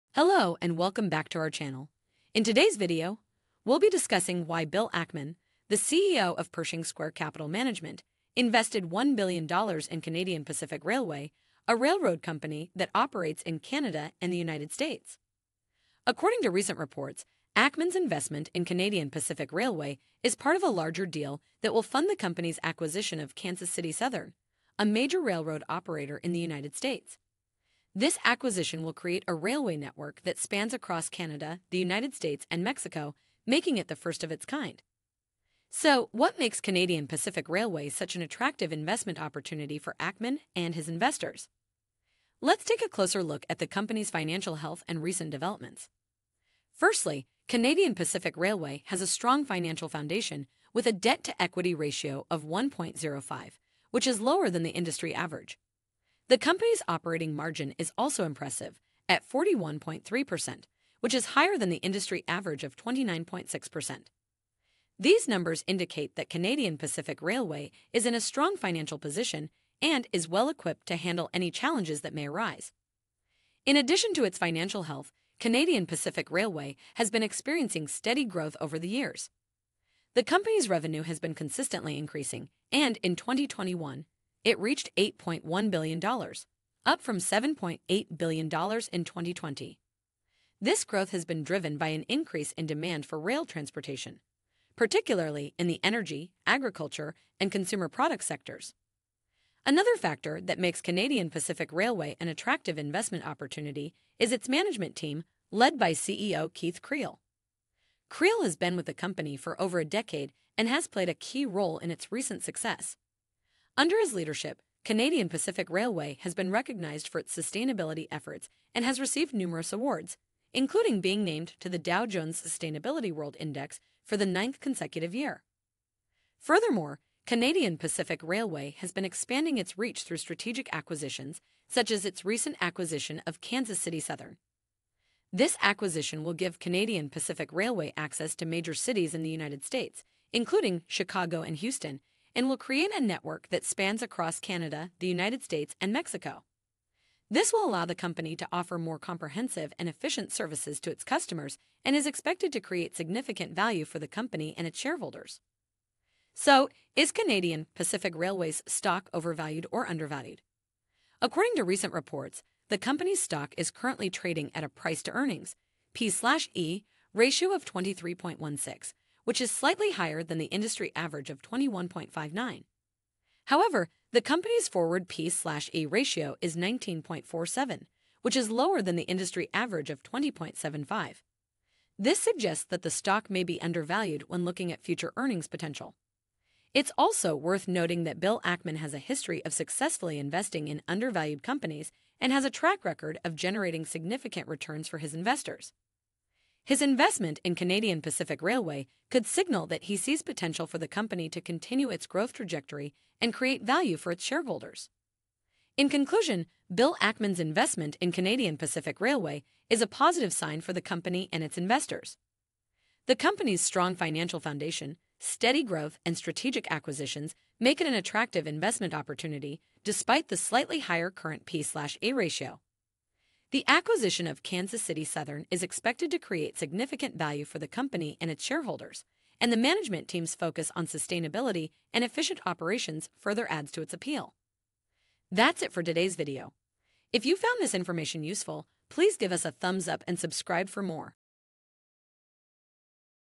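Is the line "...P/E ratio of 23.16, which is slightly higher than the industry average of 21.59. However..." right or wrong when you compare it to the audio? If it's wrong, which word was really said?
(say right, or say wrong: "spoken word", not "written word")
right.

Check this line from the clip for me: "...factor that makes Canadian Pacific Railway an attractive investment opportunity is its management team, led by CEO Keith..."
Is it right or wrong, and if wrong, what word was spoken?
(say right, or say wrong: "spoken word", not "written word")
right.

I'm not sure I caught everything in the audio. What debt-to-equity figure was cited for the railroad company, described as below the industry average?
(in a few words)
1.05.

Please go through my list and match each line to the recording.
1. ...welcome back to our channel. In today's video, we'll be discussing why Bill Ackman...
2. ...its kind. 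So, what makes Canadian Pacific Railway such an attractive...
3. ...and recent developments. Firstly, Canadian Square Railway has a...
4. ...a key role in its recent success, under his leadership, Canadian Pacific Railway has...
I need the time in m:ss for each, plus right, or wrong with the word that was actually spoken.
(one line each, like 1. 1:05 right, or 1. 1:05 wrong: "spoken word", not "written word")
1. 0:00 right
2. 0:34 right
3. 0:44 wrong: "Pacific", not "Square"
4. 1:51 right.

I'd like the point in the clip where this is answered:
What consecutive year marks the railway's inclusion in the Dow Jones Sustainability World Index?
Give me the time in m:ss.
2:04.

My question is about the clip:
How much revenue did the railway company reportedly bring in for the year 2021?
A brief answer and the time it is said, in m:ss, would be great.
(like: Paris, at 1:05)
$8.1 billion, at 1:24.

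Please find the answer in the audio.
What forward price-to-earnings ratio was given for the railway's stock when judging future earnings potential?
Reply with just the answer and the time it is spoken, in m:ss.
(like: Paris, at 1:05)
19.47, at 2:56.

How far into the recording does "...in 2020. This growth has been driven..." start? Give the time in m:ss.
1:28.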